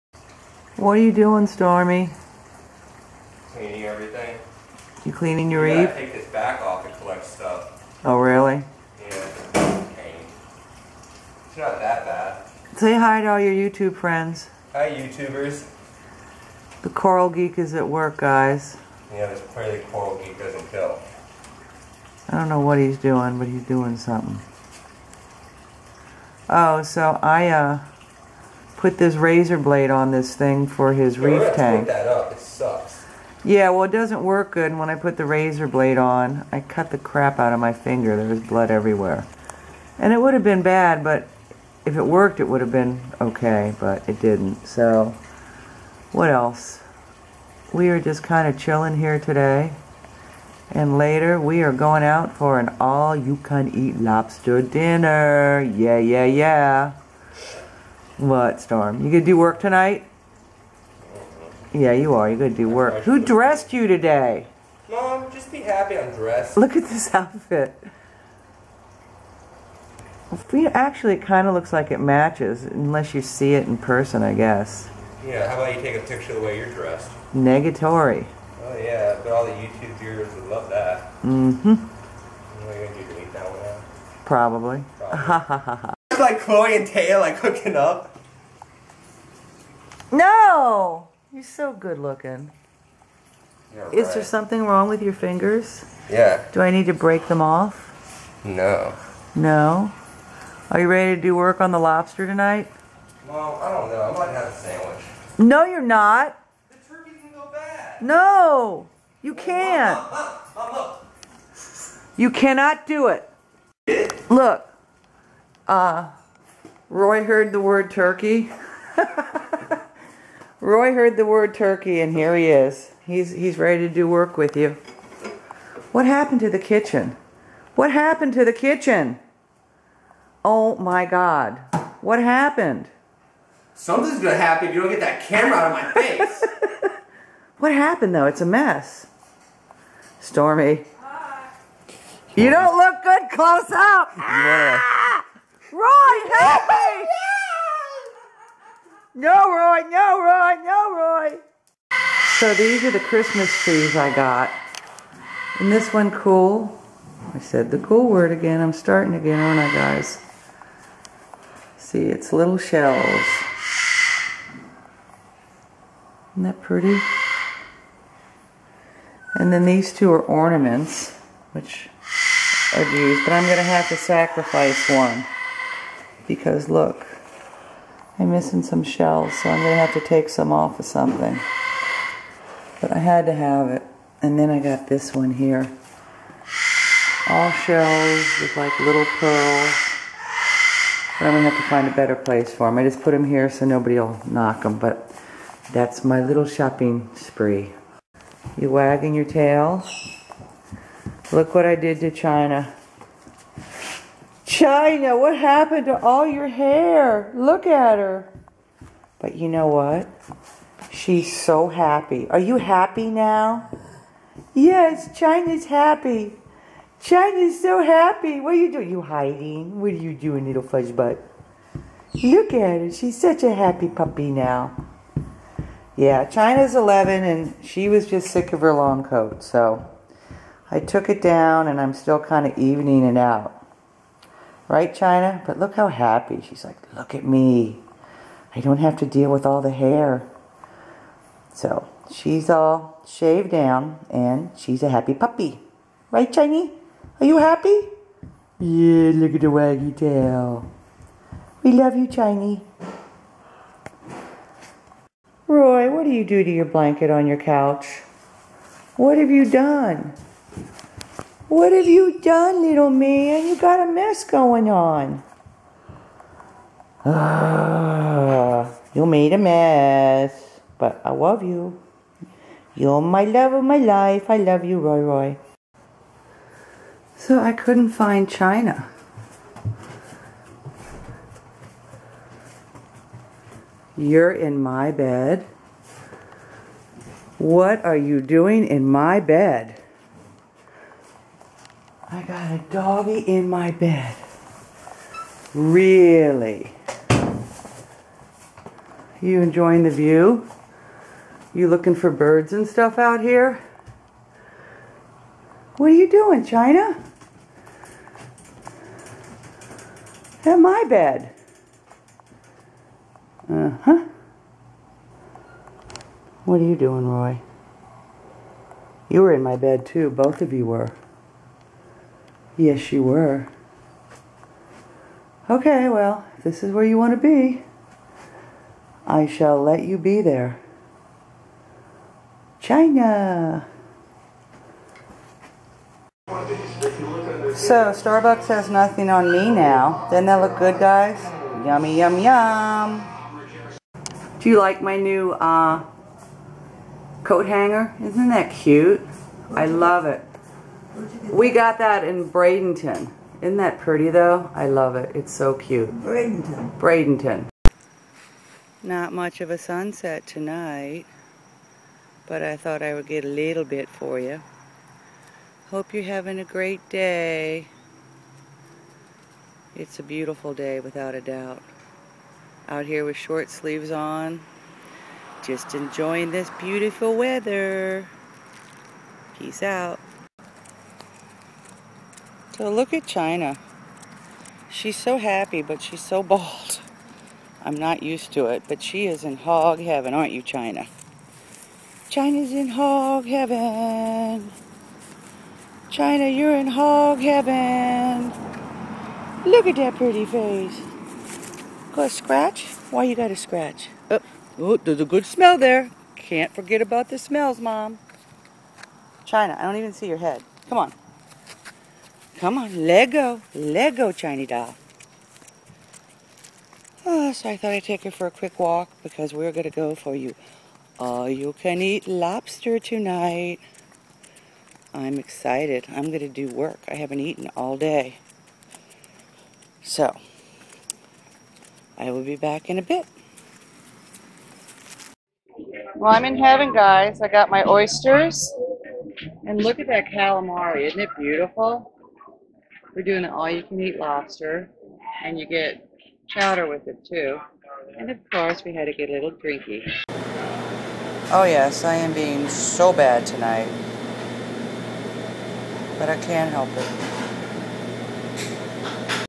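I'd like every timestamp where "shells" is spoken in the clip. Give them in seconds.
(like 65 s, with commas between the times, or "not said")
162 s, 178 s, 187 s.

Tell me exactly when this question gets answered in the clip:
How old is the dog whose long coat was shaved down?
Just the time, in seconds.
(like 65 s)
226 s.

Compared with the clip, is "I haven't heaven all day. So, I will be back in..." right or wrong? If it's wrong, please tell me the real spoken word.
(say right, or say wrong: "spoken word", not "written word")
wrong: "eaten", not "heaven".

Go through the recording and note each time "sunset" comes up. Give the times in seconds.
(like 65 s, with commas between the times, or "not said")
359 s.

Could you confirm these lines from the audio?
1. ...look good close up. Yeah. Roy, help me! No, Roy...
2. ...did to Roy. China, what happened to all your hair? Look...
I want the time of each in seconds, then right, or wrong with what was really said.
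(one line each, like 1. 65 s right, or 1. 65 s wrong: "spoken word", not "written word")
1. 142 s right
2. 201 s wrong: "China", not "Roy".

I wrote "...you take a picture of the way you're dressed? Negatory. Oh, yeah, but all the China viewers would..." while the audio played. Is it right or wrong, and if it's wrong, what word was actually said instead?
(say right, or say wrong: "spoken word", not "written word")
wrong: "YouTube", not "China".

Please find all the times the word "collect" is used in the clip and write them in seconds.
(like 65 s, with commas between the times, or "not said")
6 s.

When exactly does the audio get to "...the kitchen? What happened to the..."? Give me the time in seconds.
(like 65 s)
126 s.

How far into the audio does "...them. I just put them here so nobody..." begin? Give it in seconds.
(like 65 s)
192 s.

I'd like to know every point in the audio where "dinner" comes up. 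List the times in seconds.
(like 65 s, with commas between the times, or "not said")
54 s.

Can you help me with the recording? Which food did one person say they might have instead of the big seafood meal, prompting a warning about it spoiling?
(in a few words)
sandwich.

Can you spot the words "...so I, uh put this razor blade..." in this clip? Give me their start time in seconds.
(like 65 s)
26 s.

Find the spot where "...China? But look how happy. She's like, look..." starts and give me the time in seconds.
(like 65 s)
234 s.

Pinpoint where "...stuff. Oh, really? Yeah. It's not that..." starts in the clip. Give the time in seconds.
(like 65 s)
7 s.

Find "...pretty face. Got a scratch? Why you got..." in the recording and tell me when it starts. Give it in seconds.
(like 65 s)
399 s.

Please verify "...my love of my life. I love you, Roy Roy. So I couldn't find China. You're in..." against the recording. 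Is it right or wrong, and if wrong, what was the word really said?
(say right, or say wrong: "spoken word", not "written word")
right.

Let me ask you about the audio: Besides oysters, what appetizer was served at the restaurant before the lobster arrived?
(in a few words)
calamari.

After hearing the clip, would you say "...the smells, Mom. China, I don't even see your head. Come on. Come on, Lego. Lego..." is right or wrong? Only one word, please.
right.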